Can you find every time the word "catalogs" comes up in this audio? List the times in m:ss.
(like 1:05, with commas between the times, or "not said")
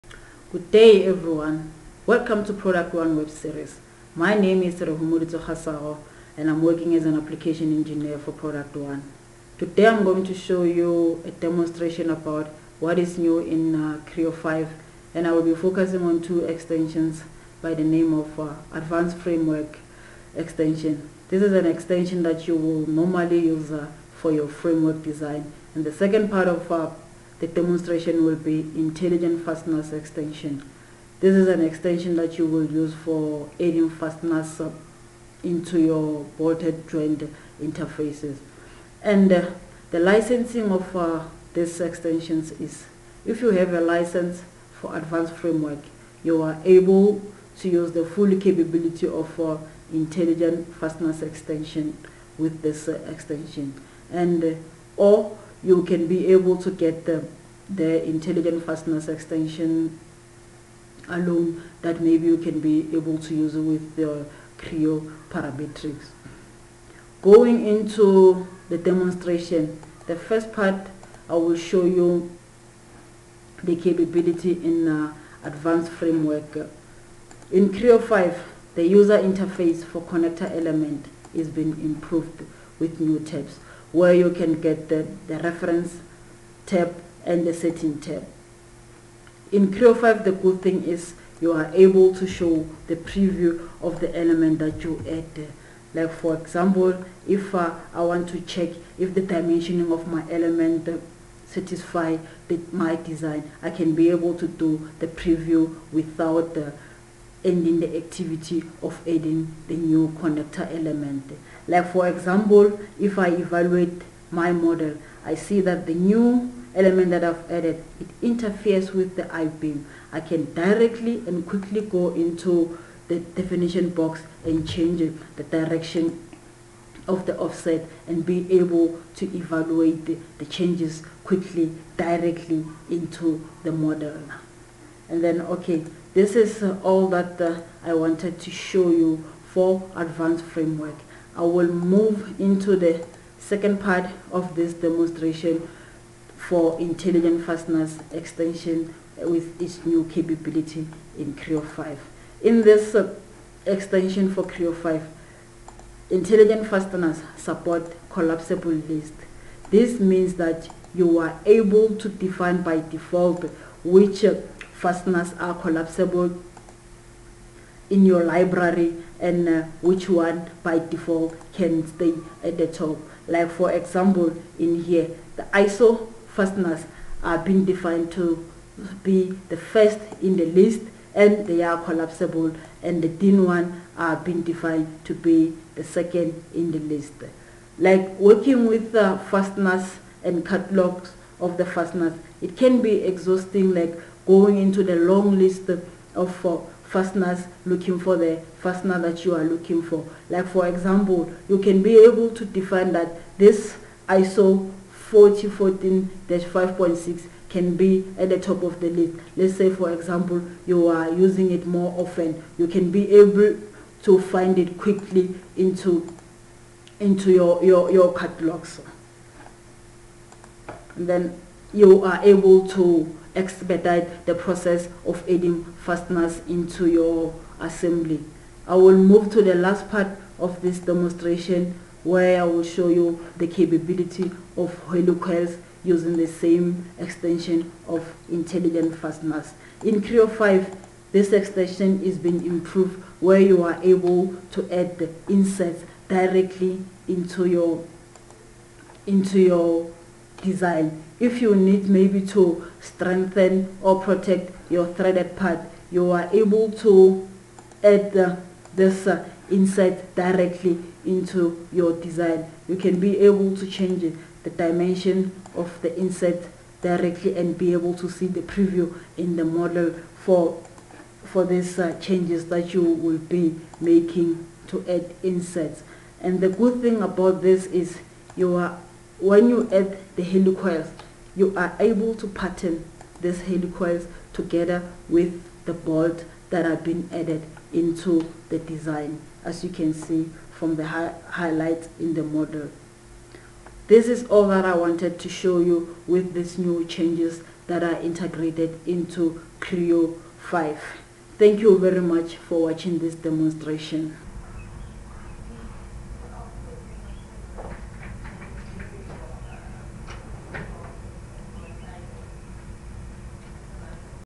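3:10, 3:38.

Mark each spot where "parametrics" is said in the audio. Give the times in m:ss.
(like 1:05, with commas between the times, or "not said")
1:05.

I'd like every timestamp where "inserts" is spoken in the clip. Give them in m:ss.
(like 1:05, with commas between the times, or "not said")
4:05, 4:25, 4:35.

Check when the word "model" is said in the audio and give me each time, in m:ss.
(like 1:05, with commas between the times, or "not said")
1:54, 2:13, 4:29, 4:52.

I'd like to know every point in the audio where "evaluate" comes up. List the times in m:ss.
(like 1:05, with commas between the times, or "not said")
1:53, 2:09.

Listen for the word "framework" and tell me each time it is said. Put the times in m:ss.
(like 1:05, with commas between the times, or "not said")
0:19, 0:24, 0:45, 1:15, 2:20.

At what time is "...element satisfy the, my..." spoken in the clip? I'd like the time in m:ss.
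1:40.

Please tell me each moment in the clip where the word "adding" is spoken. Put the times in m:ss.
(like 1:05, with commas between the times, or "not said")
0:33, 1:49, 3:45.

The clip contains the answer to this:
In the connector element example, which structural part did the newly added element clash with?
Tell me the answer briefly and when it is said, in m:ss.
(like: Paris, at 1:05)
I-beam, at 1:59.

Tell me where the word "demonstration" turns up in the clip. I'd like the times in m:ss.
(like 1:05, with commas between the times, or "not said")
0:11, 0:27, 1:08, 2:24, 3:50, 5:03.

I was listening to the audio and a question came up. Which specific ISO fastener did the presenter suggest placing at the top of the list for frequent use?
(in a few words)
ISO 4014-5.6.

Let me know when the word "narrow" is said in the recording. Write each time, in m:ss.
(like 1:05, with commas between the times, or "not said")
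not said.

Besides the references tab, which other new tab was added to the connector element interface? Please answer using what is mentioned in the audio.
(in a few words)
setting tab.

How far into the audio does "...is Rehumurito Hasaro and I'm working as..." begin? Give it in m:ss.
0:04.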